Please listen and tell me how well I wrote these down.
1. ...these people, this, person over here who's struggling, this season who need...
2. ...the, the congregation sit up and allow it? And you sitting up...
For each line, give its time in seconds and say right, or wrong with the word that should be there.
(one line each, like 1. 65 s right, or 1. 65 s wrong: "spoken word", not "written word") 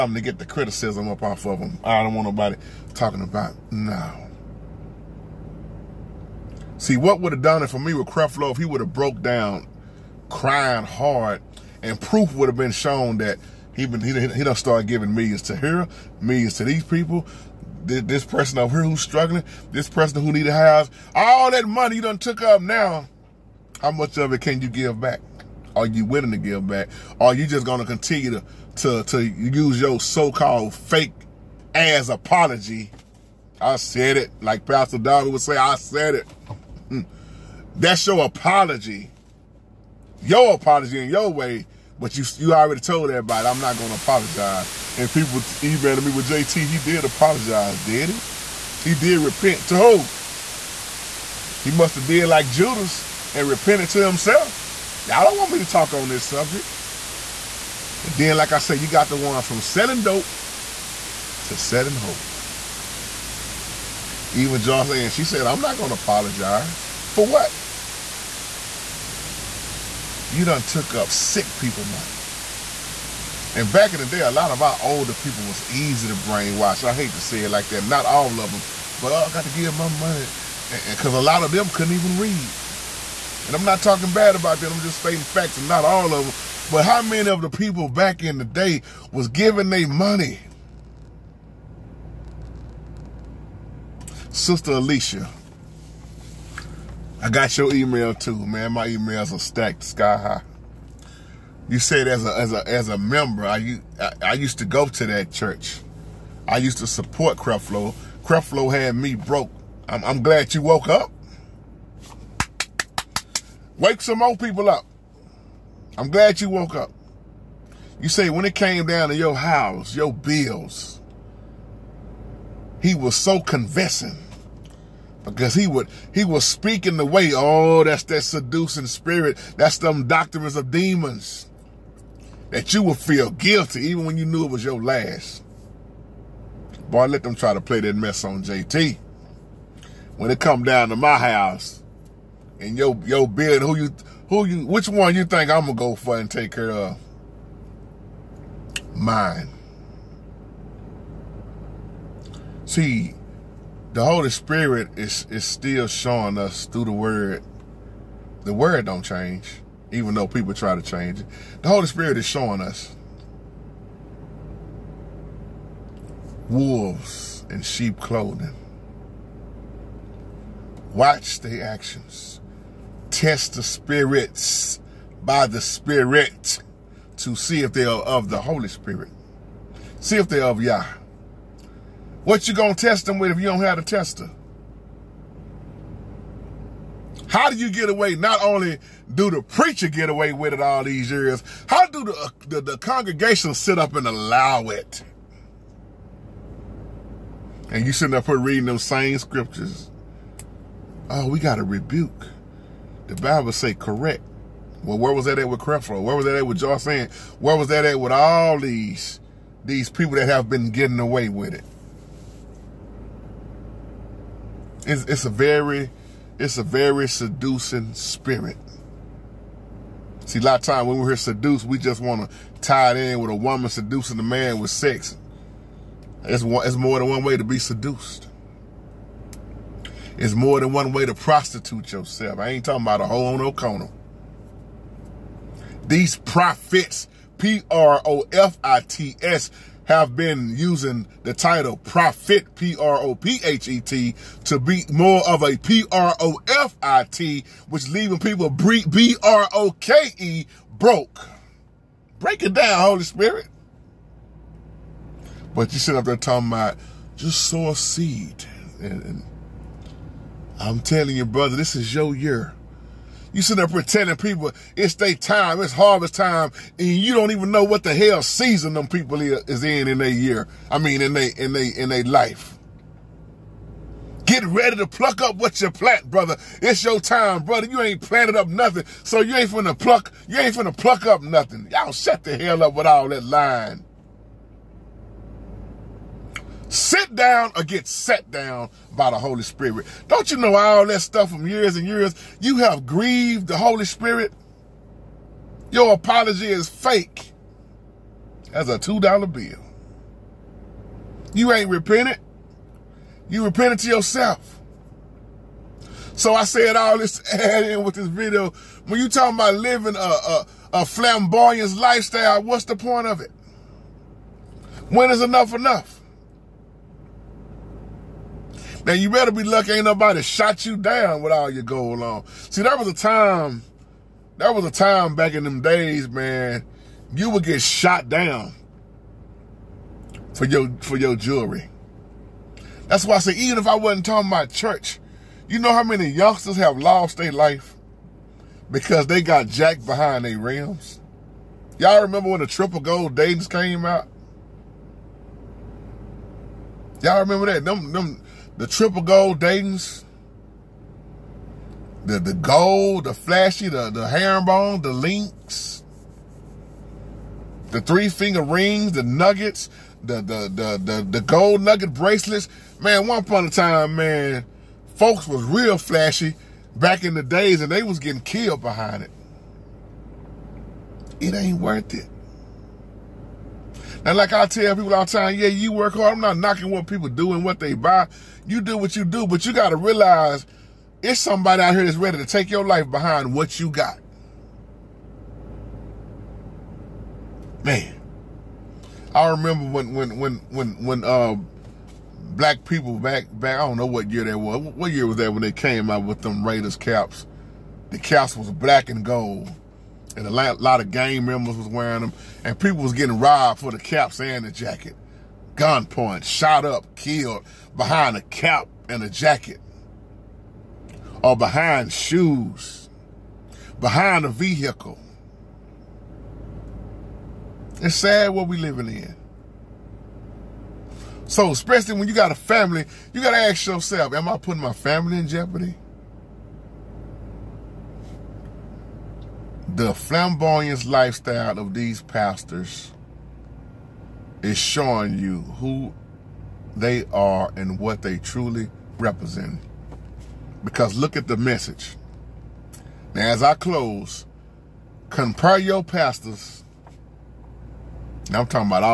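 1. 16 s wrong: "person", not "season"
2. 192 s right.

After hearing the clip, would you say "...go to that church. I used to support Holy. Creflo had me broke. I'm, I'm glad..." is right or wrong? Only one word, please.
wrong.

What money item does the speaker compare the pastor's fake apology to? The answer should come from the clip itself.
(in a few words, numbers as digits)
$2 bill.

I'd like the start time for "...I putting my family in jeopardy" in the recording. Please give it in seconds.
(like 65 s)
424 s.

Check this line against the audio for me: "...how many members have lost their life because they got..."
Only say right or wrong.
wrong.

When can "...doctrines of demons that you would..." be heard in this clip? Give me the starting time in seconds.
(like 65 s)
130 s.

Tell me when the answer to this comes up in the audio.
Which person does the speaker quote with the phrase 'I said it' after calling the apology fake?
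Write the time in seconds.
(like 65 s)
34 s.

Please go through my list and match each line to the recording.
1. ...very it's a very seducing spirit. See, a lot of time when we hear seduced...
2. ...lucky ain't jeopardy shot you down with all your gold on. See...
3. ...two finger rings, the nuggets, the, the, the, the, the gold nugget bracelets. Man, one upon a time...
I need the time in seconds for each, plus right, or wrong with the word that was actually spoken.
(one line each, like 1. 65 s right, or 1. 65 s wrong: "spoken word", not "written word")
1. 215 s right
2. 319 s wrong: "nobody", not "jeopardy"
3. 357 s wrong: "three", not "two".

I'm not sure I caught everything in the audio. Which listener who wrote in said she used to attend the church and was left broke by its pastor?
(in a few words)
Sister Alicia.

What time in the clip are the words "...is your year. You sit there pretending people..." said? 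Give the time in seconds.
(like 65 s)
261 s.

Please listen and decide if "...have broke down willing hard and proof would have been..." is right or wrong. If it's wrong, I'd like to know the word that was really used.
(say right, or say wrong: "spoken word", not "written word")
wrong: "crying", not "willing".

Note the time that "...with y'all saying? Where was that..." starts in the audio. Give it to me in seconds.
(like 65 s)
206 s.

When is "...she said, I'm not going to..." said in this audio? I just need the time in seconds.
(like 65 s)
65 s.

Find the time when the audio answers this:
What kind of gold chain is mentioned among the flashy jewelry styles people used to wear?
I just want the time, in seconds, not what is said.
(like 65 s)
354 s.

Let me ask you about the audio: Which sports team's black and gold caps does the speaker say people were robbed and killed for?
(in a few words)
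Raiders.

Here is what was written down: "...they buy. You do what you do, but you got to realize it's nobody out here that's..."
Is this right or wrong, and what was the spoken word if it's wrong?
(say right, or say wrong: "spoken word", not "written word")
wrong: "somebody", not "nobody".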